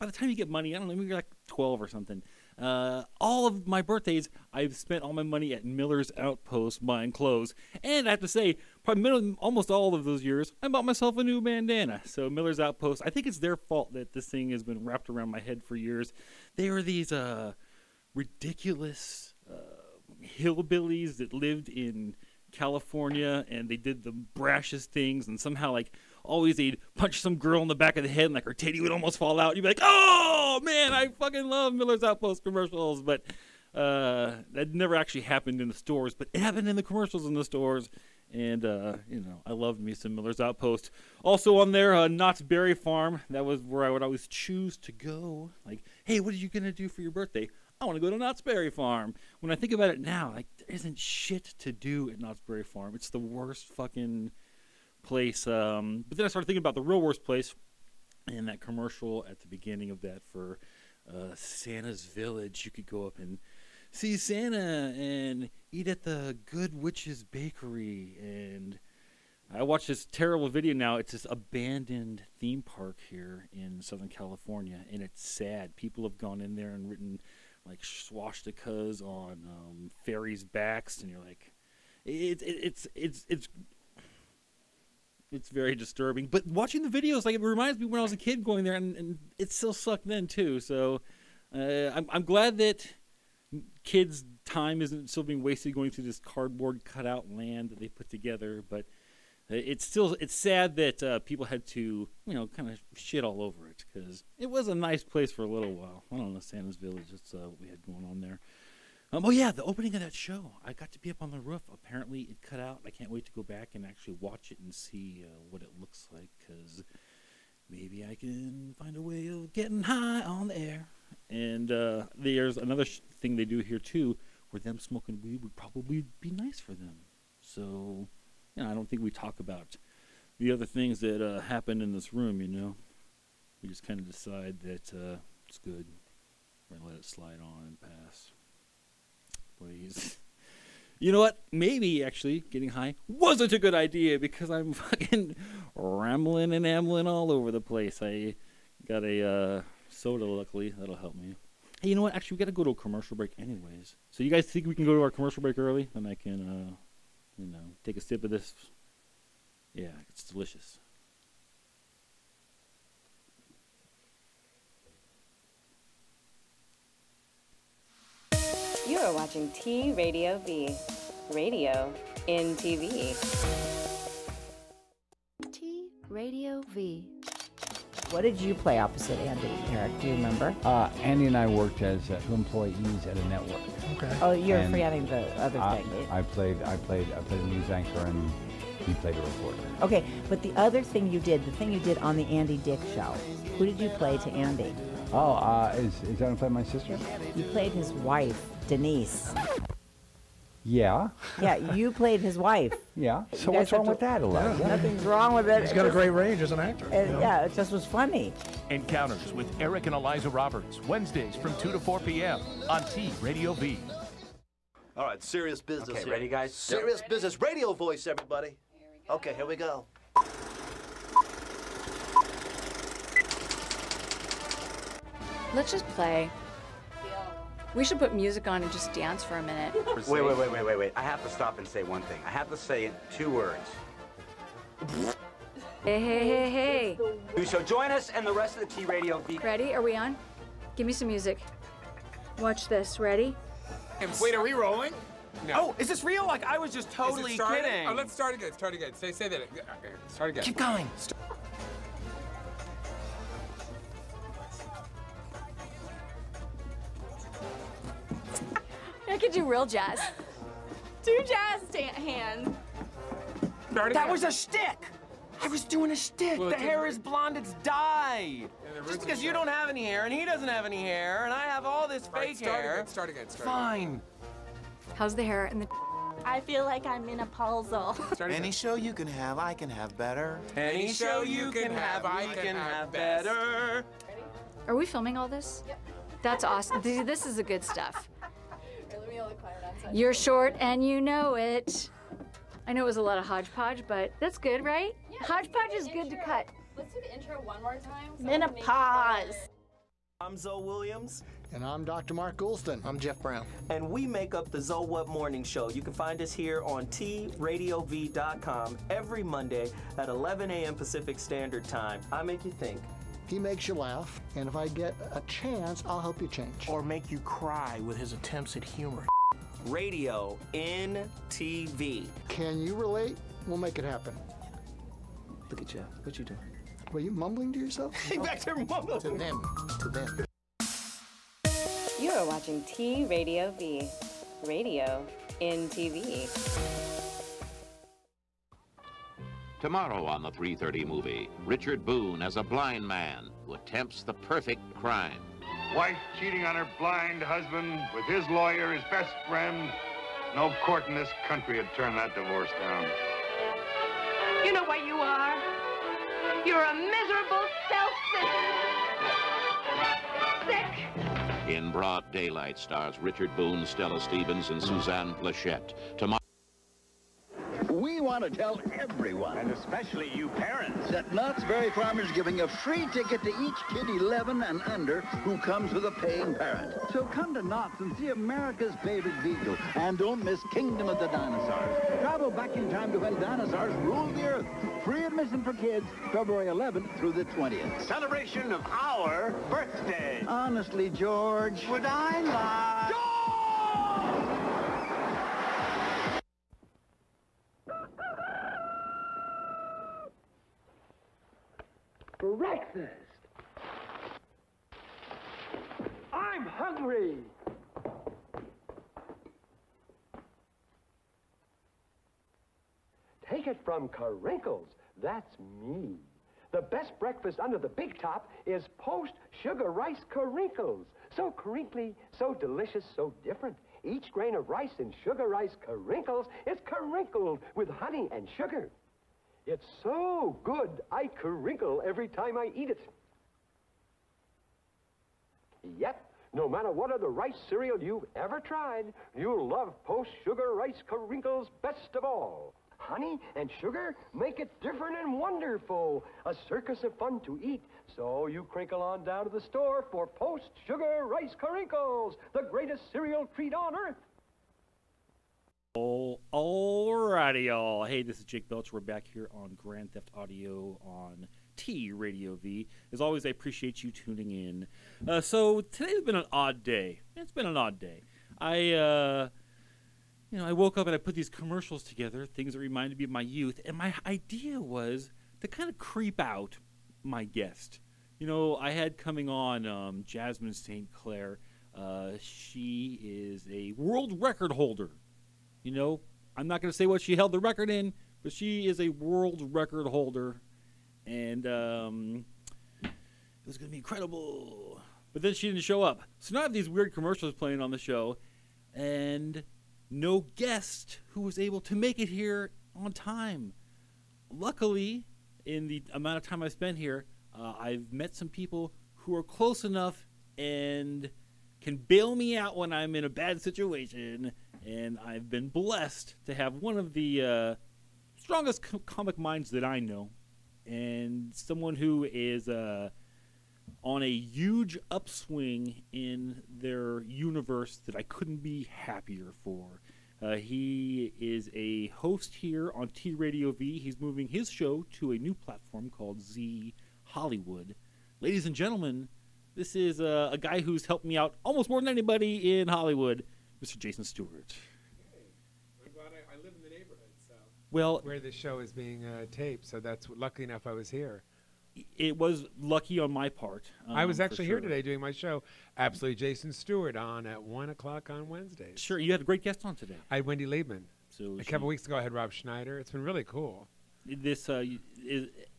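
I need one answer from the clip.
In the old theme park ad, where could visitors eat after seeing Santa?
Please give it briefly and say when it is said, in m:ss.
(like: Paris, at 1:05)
Good Witch's Bakery, at 1:06.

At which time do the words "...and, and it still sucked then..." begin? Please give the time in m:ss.
1:28.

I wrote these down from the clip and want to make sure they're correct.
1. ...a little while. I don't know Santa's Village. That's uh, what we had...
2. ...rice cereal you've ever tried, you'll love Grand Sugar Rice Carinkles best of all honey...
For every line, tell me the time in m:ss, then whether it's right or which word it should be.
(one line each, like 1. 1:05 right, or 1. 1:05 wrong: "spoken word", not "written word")
1. 1:45 right
2. 7:17 wrong: "Post", not "Grand".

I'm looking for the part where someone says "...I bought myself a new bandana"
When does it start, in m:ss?
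0:10.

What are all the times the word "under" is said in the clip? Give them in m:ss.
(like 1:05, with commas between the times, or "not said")
6:14, 6:57.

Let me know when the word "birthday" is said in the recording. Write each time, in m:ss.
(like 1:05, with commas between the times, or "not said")
0:03, 0:47, 6:29.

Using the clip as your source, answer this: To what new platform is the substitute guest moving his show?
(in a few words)
Z Hollywood.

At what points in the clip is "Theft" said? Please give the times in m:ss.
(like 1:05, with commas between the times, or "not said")
7:39.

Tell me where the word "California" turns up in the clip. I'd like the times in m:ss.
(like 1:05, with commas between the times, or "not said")
0:22, 1:14.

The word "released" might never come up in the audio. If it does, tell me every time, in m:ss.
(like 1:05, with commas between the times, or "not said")
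not said.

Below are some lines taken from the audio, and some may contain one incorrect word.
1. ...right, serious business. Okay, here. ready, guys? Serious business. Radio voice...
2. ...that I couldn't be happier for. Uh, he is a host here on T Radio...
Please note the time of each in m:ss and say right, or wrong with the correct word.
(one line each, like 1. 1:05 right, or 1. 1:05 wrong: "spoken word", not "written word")
1. 3:35 right
2. 8:47 right.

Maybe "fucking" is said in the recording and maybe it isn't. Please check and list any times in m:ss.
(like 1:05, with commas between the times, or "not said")
0:31, 0:53, 2:24.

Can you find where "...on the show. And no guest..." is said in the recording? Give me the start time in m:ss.
8:17.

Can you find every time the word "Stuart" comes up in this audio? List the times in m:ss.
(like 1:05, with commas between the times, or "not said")
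9:04, 9:16.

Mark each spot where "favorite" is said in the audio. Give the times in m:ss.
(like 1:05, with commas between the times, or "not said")
6:18.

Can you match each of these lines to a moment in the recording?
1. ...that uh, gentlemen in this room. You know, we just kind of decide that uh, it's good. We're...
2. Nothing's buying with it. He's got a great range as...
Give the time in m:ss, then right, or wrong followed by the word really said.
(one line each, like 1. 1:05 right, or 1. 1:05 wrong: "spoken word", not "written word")
1. 2:11 wrong: "happen", not "gentlemen"
2. 3:24 wrong: "wrong", not "buying".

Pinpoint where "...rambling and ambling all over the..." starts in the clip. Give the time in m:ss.
2:25.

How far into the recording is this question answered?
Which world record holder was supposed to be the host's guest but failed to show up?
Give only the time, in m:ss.
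8:00.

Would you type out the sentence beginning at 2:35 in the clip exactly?
Then I can, uh, you know, take a sip of this.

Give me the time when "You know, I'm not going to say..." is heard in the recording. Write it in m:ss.
8:05.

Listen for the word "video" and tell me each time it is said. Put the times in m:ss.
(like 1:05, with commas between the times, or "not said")
1:10, 1:26.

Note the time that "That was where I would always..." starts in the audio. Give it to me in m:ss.
0:43.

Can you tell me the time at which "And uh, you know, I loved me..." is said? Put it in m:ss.
0:38.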